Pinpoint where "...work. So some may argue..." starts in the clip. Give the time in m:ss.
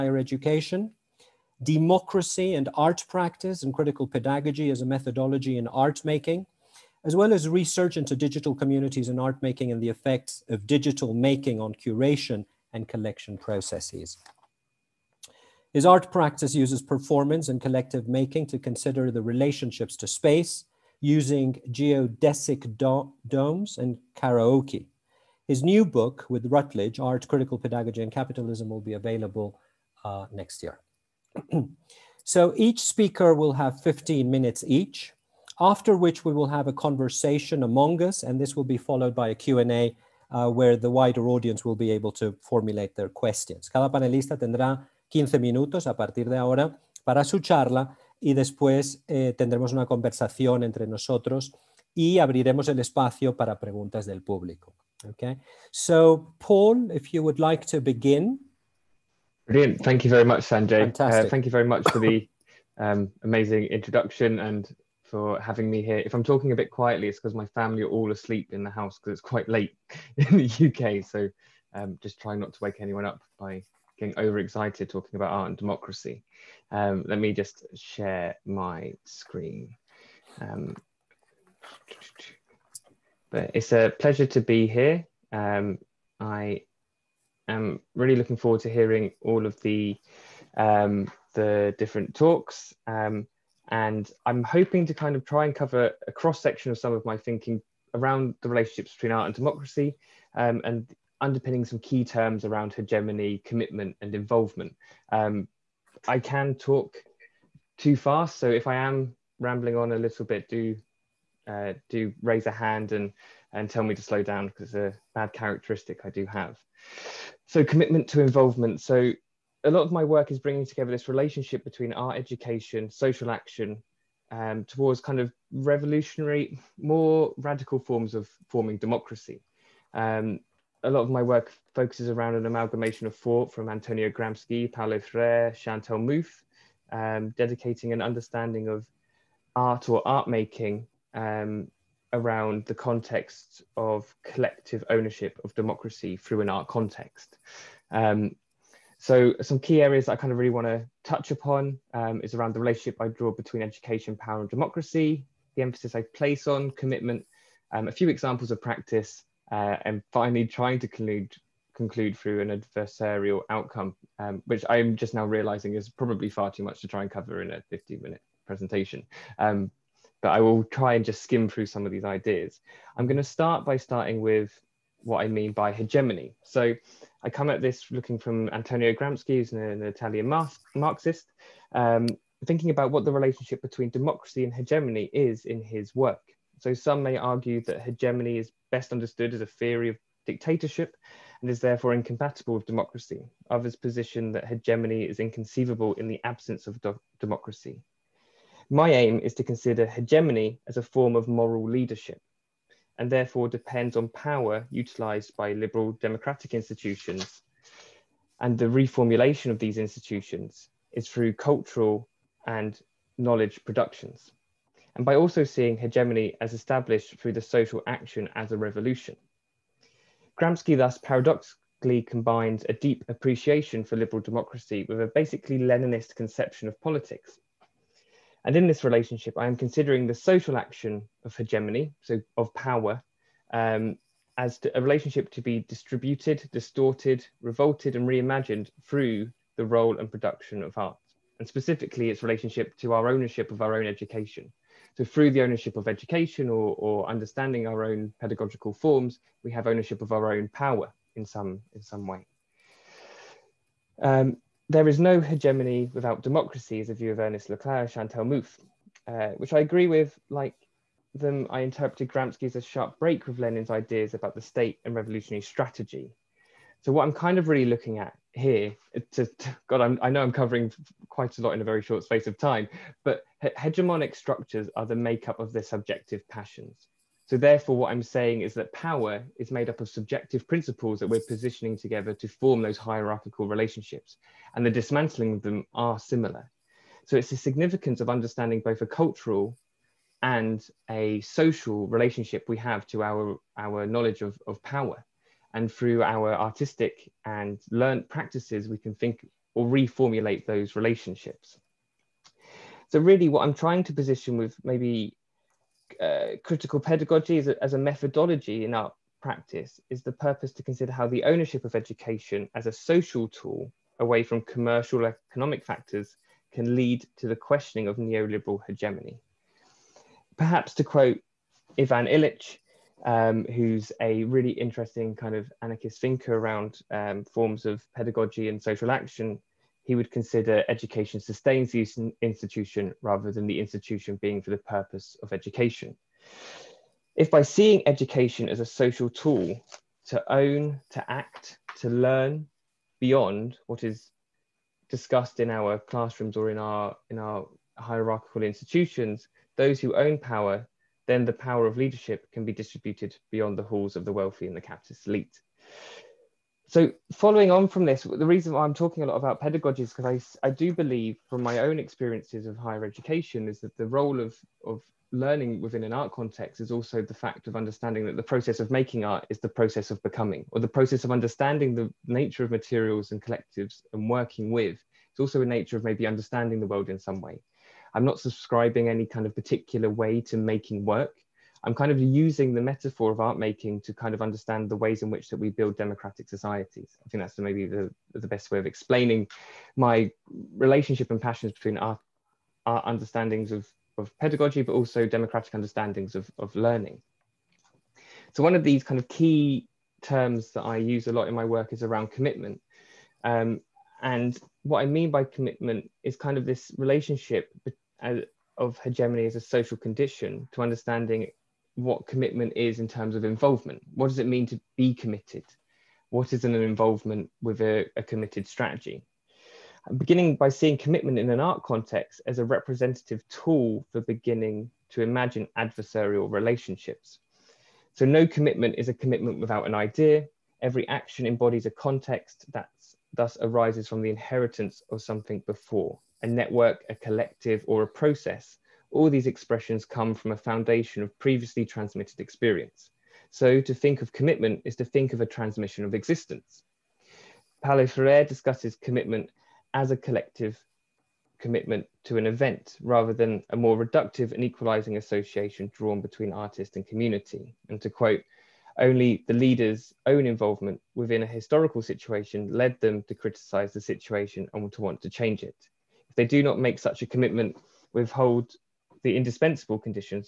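3:05.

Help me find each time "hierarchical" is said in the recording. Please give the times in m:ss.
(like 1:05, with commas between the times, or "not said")
4:42, 5:47.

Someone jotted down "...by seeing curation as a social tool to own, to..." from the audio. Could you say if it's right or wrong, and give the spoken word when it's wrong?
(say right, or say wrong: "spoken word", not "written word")
wrong: "education", not "curation".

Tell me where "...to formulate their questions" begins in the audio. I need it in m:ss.
0:42.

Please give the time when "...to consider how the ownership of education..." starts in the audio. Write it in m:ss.
5:10.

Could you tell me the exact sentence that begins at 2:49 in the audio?
Um, but I will try and just skim through some of these ideas.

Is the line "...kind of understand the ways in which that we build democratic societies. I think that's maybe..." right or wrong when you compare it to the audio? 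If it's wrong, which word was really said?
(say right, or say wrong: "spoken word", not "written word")
right.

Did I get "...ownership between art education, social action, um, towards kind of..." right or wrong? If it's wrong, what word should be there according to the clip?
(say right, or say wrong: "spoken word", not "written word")
wrong: "relationship", not "ownership".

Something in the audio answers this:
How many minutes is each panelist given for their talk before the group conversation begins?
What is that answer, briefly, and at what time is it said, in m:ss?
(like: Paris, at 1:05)
15, at 0:33.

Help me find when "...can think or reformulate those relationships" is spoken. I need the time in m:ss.
4:58.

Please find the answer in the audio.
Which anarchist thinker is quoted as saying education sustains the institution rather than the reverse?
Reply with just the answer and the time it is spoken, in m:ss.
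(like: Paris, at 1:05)
Ivan Illich, at 5:21.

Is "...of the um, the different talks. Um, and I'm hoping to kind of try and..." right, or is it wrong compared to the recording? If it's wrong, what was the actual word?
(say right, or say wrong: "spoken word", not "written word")
right.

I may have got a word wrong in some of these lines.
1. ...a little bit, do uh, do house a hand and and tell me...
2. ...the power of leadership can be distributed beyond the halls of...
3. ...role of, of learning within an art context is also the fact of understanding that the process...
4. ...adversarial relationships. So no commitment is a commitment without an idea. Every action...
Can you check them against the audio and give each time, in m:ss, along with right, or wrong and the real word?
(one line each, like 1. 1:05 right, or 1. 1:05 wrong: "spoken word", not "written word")
1. 1:49 wrong: "raise", not "house"
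2. 5:51 right
3. 6:03 right
4. 7:05 right.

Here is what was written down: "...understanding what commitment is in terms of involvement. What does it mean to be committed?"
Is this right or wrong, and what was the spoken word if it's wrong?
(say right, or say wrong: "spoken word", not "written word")
right.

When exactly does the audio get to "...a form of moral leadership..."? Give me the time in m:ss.
3:20.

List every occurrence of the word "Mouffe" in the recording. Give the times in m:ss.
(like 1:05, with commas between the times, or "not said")
2:15, 4:18.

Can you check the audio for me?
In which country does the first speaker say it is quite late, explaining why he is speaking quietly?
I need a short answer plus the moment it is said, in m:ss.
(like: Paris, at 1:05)
UK, at 1:10.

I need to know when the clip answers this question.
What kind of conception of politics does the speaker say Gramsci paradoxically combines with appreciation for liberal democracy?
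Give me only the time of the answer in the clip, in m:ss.
3:45.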